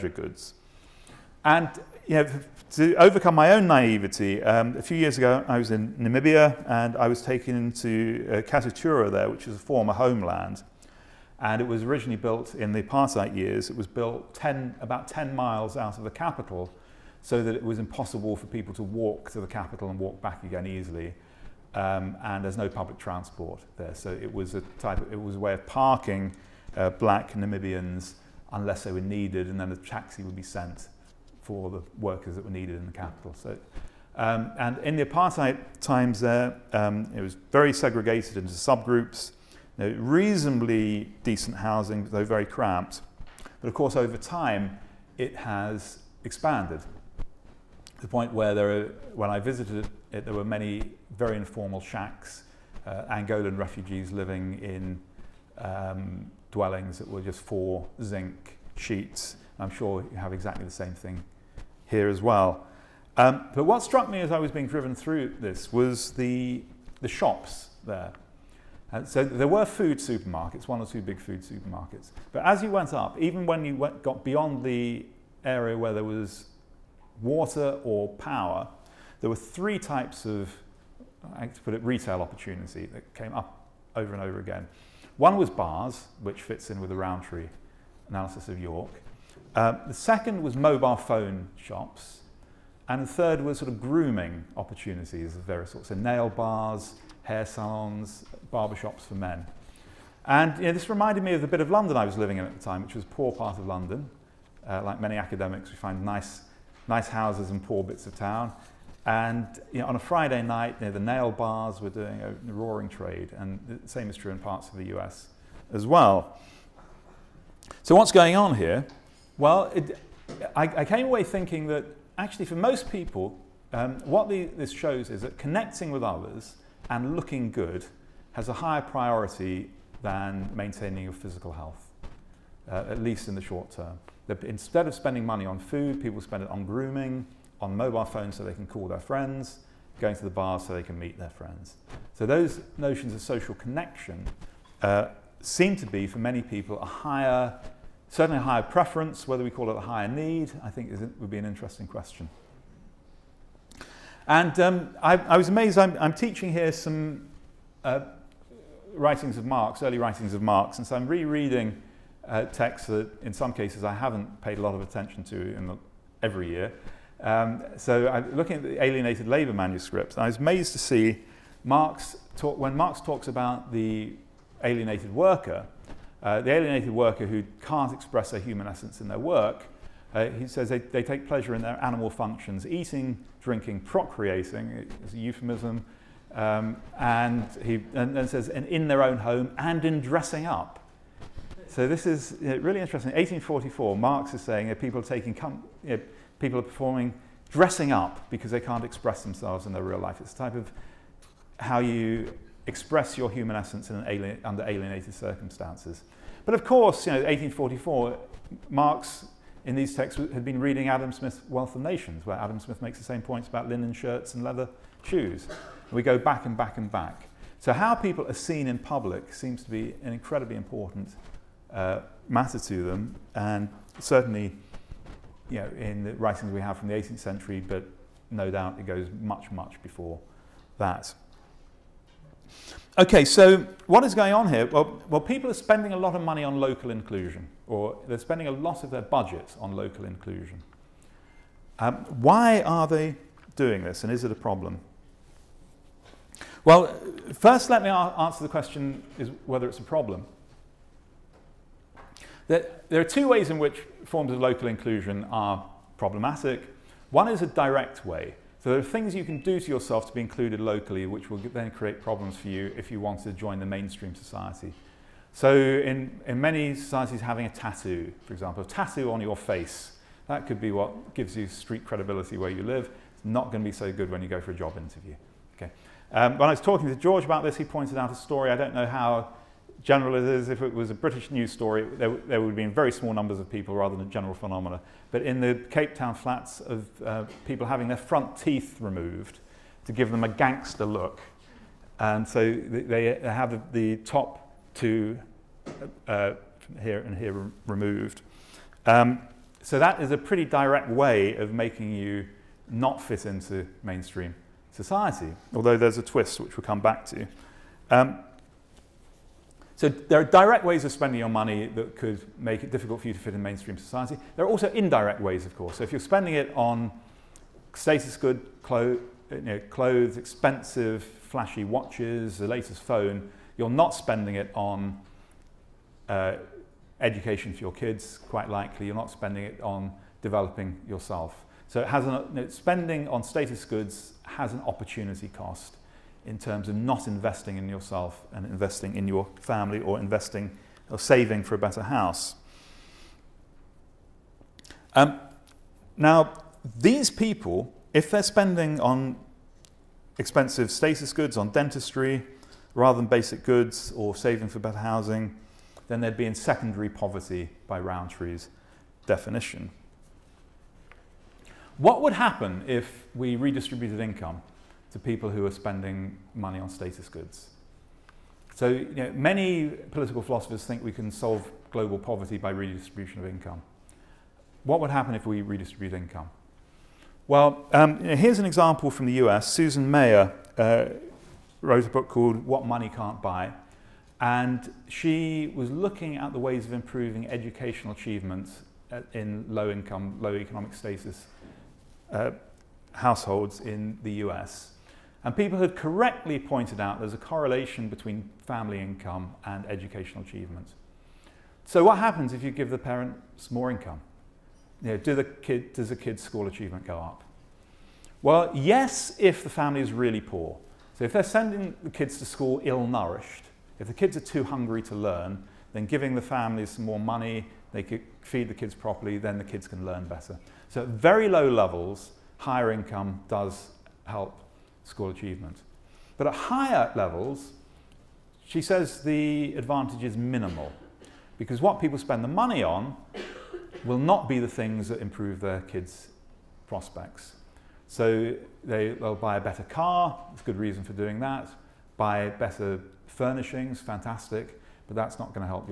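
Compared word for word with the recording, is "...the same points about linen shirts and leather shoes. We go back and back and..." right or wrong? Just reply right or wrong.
right.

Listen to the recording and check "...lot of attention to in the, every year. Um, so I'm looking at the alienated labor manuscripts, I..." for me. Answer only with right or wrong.
right.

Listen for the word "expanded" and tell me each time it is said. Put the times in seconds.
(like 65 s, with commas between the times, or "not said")
46 s.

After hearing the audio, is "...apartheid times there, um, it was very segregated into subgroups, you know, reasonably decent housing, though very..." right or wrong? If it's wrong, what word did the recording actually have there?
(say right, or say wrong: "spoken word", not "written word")
right.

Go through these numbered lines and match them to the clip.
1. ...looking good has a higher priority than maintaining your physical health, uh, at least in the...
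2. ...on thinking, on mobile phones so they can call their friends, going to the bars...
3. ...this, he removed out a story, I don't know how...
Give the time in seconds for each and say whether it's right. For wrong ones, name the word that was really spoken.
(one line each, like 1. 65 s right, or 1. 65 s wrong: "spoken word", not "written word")
1. 127 s right
2. 136 s wrong: "grooming", not "thinking"
3. 277 s wrong: "pointed", not "removed".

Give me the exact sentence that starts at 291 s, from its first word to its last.
And so they, they have the, the, top two uh, here and here removed.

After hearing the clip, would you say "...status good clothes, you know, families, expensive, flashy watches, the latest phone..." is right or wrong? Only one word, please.
wrong.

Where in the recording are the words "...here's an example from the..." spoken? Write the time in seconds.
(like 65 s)
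378 s.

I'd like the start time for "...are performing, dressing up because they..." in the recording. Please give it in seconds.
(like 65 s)
196 s.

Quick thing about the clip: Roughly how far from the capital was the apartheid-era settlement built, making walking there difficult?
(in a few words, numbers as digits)
10 miles.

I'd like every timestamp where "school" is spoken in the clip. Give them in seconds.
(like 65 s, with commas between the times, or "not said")
406 s, 412 s, 424 s.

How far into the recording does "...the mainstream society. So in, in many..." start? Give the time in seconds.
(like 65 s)
263 s.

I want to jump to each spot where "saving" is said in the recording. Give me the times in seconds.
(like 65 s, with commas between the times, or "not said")
340 s, 354 s.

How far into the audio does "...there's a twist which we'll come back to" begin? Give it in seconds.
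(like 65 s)
305 s.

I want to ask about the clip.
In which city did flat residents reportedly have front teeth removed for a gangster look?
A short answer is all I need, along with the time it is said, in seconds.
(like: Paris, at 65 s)
Cape Town, at 285 s.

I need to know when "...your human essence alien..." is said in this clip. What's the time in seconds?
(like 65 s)
203 s.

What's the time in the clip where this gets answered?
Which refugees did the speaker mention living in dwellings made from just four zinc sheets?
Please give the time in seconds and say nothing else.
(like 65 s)
53 s.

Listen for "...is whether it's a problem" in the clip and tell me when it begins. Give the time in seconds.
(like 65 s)
249 s.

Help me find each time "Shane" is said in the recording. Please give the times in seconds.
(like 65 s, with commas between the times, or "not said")
not said.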